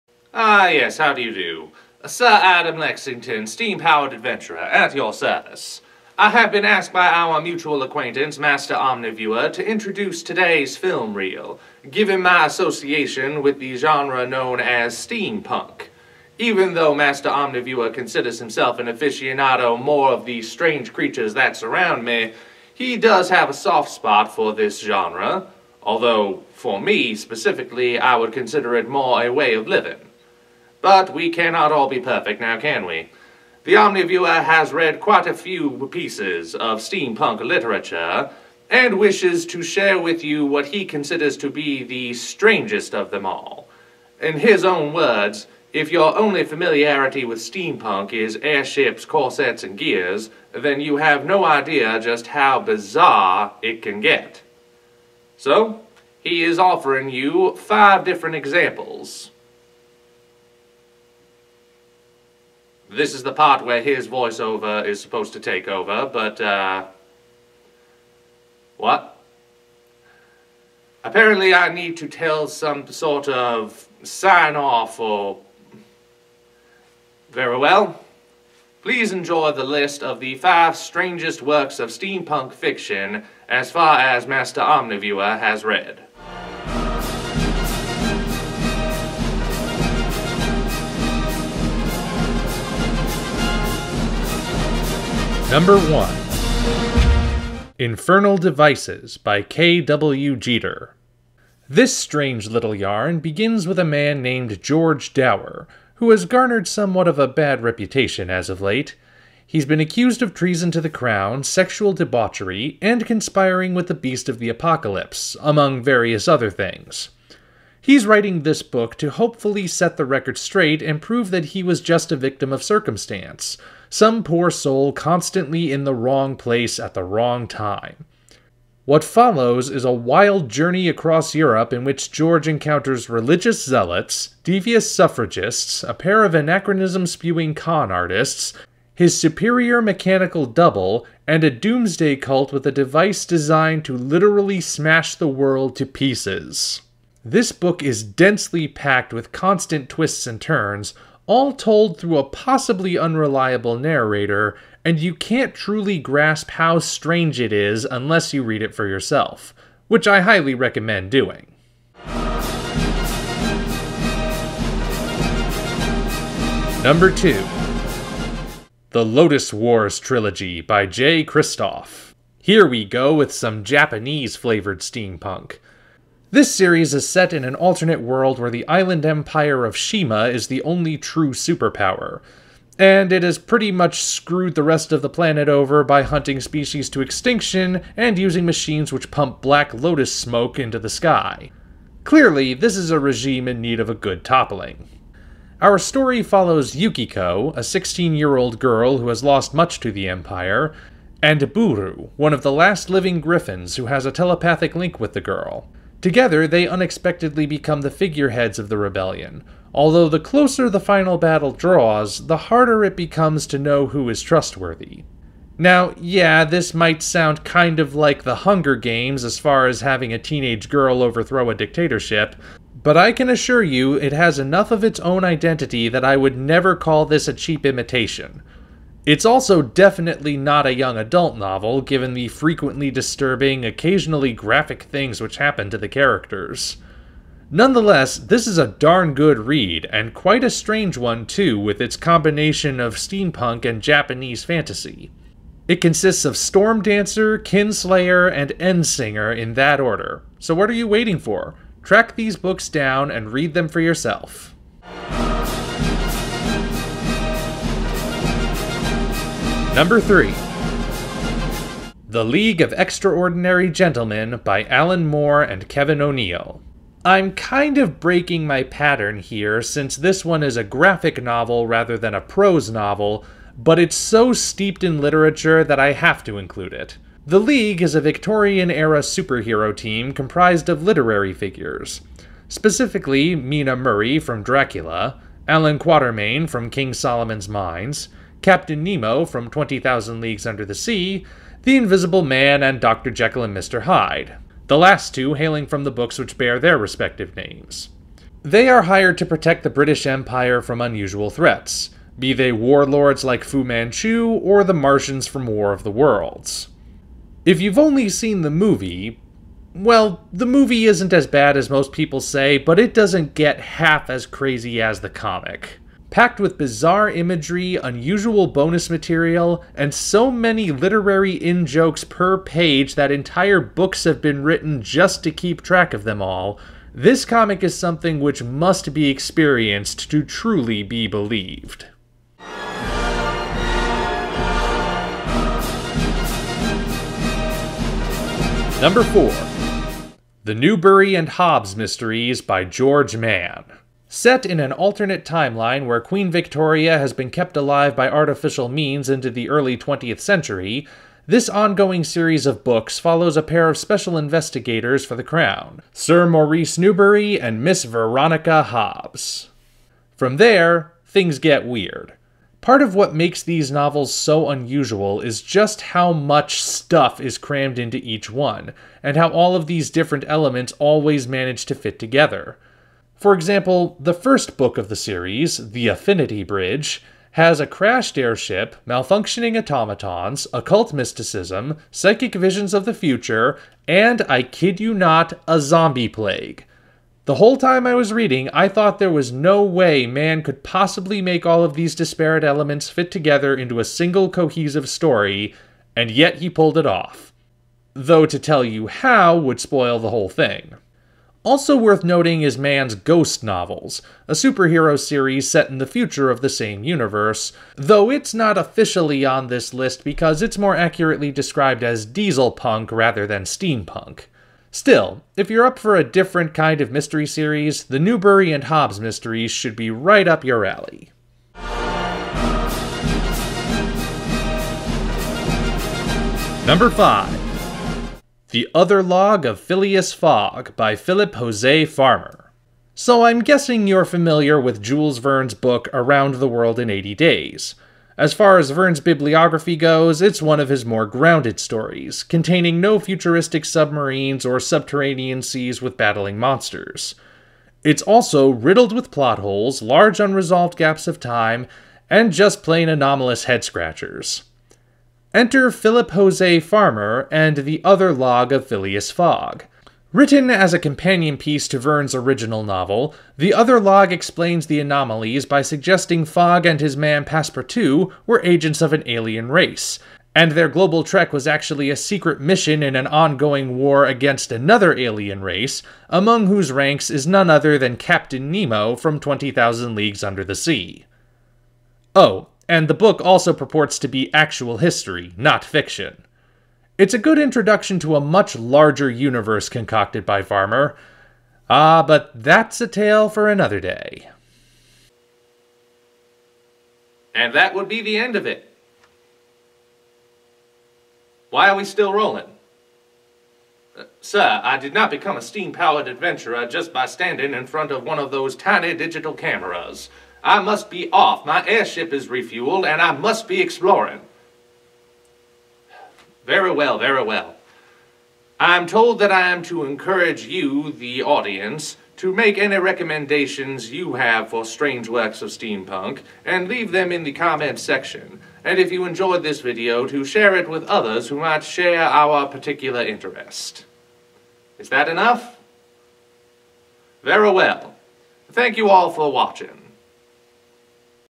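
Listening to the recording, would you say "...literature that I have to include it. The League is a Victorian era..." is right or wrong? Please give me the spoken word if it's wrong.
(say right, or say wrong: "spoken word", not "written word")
right.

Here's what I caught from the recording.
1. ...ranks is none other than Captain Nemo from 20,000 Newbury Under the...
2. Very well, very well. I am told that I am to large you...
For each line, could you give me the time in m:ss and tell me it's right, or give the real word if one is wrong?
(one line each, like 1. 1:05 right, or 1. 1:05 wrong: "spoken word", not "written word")
1. 7:56 wrong: "Leagues", not "Newbury"
2. 8:36 wrong: "encourage", not "large".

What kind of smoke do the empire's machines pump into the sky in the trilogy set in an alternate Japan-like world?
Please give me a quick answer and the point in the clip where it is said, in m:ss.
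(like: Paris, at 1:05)
black lotus smoke, at 3:09.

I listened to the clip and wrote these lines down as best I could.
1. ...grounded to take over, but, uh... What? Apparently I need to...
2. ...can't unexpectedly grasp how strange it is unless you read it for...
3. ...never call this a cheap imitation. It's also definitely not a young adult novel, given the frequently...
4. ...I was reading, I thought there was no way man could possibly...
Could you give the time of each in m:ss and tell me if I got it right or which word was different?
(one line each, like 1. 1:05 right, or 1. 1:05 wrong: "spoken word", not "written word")
1. 1:04 wrong: "supposed", not "grounded"
2. 2:35 wrong: "truly", not "unexpectedly"
3. 3:46 right
4. 6:27 right.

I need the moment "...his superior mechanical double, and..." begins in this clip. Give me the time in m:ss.
2:18.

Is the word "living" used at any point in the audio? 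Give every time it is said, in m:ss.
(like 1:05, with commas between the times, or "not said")
0:29, 3:22.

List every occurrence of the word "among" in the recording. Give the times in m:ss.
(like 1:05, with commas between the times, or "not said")
1:55, 7:56.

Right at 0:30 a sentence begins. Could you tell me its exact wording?
But we cannot all be perfect now, can we?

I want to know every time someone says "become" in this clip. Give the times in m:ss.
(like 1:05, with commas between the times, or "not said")
3:27, 3:32, 8:25.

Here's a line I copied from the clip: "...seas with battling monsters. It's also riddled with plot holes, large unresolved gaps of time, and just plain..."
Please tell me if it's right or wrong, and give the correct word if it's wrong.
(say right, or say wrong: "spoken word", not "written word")
right.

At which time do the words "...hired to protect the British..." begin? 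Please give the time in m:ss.
4:58.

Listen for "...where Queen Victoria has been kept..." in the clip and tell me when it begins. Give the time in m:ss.
5:45.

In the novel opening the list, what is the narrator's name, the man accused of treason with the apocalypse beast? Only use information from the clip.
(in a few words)
George Dower.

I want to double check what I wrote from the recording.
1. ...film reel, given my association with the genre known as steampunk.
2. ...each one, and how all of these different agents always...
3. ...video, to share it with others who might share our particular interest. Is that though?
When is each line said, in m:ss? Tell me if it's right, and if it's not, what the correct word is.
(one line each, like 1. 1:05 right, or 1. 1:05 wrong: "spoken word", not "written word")
1. 0:10 right
2. 6:07 wrong: "elements", not "agents"
3. 8:49 wrong: "enough", not "though".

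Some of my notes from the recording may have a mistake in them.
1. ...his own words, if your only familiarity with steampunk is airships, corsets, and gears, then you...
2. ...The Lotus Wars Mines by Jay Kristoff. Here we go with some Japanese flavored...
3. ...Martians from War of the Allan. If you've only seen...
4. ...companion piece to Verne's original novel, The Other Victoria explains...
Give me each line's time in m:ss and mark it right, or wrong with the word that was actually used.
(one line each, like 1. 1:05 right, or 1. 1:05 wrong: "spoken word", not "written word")
1. 0:44 right
2. 2:48 wrong: "Trilogy", not "Mines"
3. 5:04 wrong: "Worlds", not "Allan"
4. 7:40 wrong: "Log", not "Victoria".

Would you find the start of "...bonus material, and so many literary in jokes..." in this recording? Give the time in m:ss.
5:18.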